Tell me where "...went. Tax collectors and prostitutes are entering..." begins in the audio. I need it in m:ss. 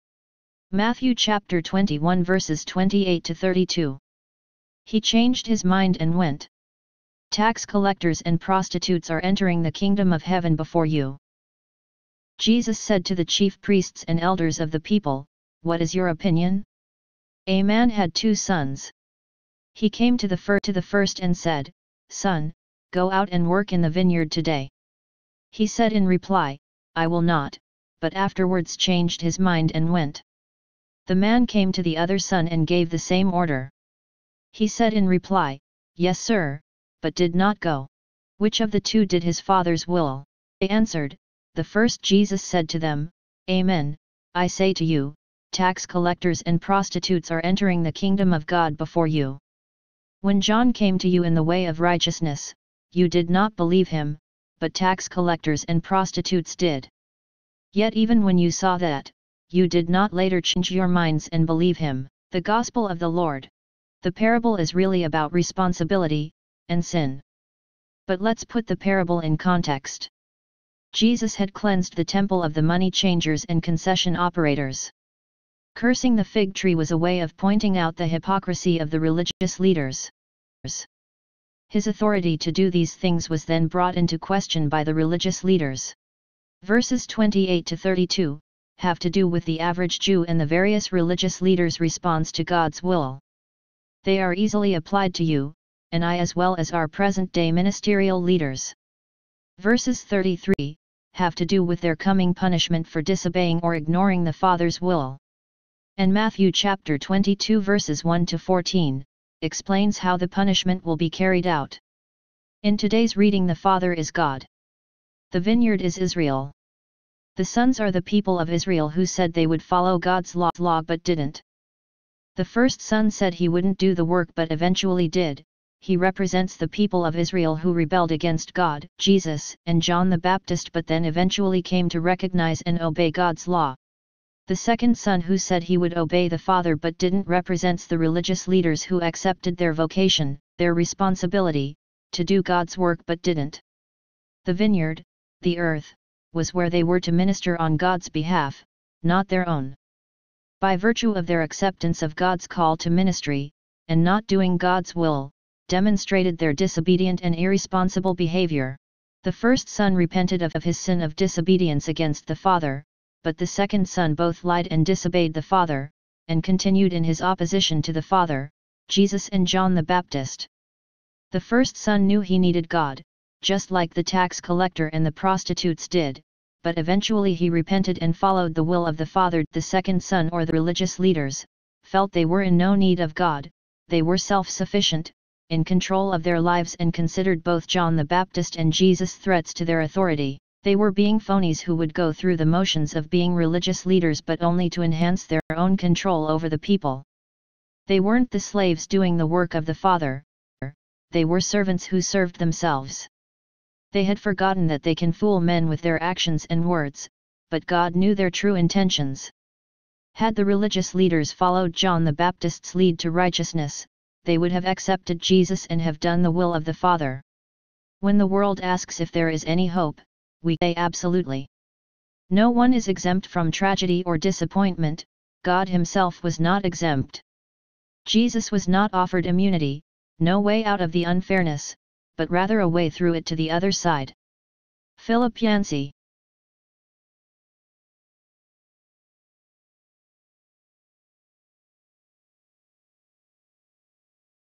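0:06.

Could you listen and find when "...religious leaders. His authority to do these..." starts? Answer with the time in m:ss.
1:19.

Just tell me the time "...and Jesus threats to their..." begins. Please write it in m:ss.
3:08.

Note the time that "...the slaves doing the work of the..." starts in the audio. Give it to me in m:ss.
3:18.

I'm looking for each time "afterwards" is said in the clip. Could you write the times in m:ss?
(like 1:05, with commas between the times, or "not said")
0:28.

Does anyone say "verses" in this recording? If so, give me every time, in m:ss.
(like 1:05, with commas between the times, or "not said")
0:02, 1:26, 1:39, 1:47.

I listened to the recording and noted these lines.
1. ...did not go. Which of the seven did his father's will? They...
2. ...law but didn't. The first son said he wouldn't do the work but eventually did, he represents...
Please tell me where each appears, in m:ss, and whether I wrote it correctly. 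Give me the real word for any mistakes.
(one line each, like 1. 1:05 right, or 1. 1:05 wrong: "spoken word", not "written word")
1. 0:37 wrong: "two", not "seven"
2. 2:00 right.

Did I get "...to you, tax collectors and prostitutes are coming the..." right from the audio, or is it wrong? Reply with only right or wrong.
wrong.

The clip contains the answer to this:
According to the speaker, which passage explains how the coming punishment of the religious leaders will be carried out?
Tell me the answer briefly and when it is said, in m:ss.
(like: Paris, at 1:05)
Matthew 22:1-14, at 1:46.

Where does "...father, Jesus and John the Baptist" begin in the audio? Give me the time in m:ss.
2:48.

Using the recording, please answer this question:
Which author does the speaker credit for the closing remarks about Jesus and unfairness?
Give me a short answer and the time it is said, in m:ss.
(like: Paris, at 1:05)
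Philip Yancey, at 3:54.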